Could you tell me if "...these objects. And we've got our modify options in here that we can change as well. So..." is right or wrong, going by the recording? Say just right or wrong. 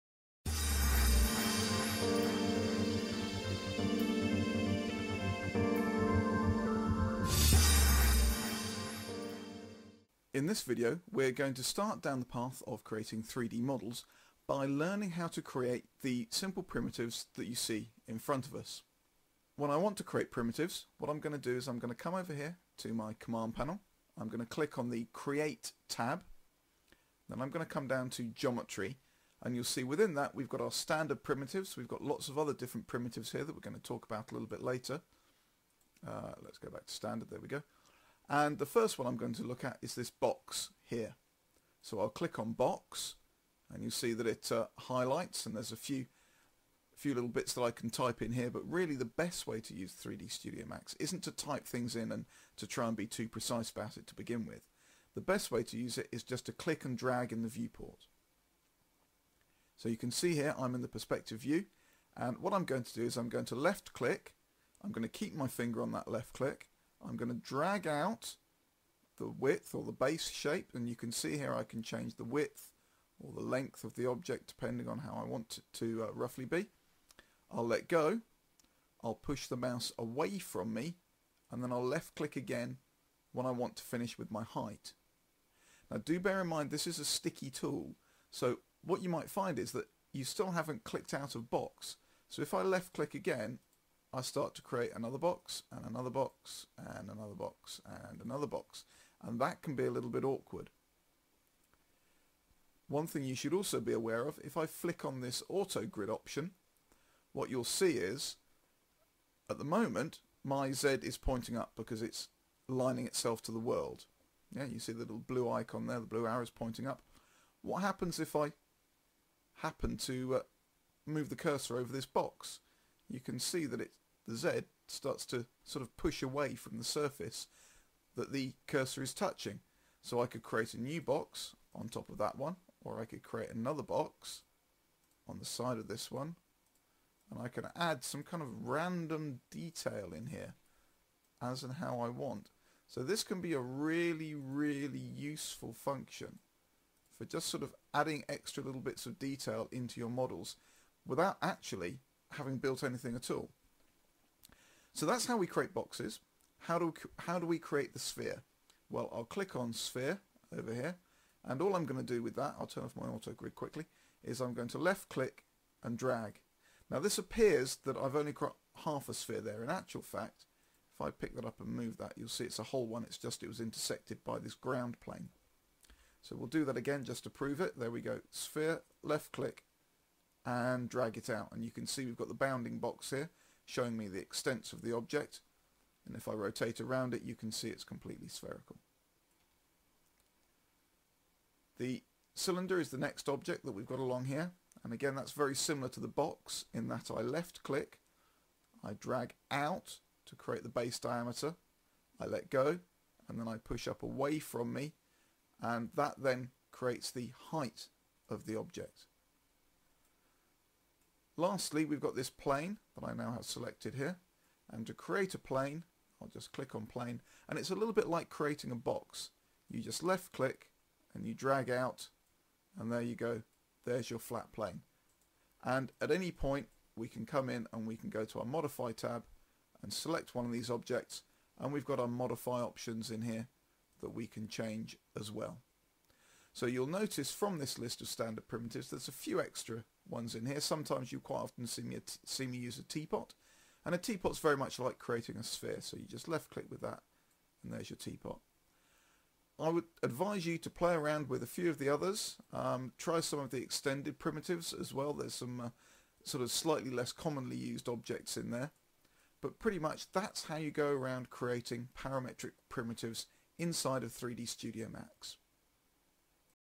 right.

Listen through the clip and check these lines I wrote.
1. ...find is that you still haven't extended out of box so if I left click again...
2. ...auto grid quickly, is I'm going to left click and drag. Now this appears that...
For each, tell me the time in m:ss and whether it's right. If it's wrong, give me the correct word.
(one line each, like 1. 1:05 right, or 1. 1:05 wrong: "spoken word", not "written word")
1. 1:29 wrong: "clicked", not "extended"
2. 2:43 right.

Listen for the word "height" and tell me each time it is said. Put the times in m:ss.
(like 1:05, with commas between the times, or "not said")
1:24, 3:27.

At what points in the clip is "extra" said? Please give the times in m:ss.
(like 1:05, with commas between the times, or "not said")
2:28, 3:59.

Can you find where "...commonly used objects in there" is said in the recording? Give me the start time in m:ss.
4:17.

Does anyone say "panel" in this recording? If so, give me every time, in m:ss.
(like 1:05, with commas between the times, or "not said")
0:23.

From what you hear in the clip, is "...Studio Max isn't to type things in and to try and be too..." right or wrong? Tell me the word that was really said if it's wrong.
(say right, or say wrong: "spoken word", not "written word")
right.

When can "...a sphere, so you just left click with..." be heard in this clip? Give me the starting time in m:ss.
4:05.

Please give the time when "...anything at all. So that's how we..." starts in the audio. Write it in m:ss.
2:32.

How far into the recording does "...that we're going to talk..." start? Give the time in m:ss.
0:33.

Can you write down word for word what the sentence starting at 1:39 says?
And that can be a little bit awkward.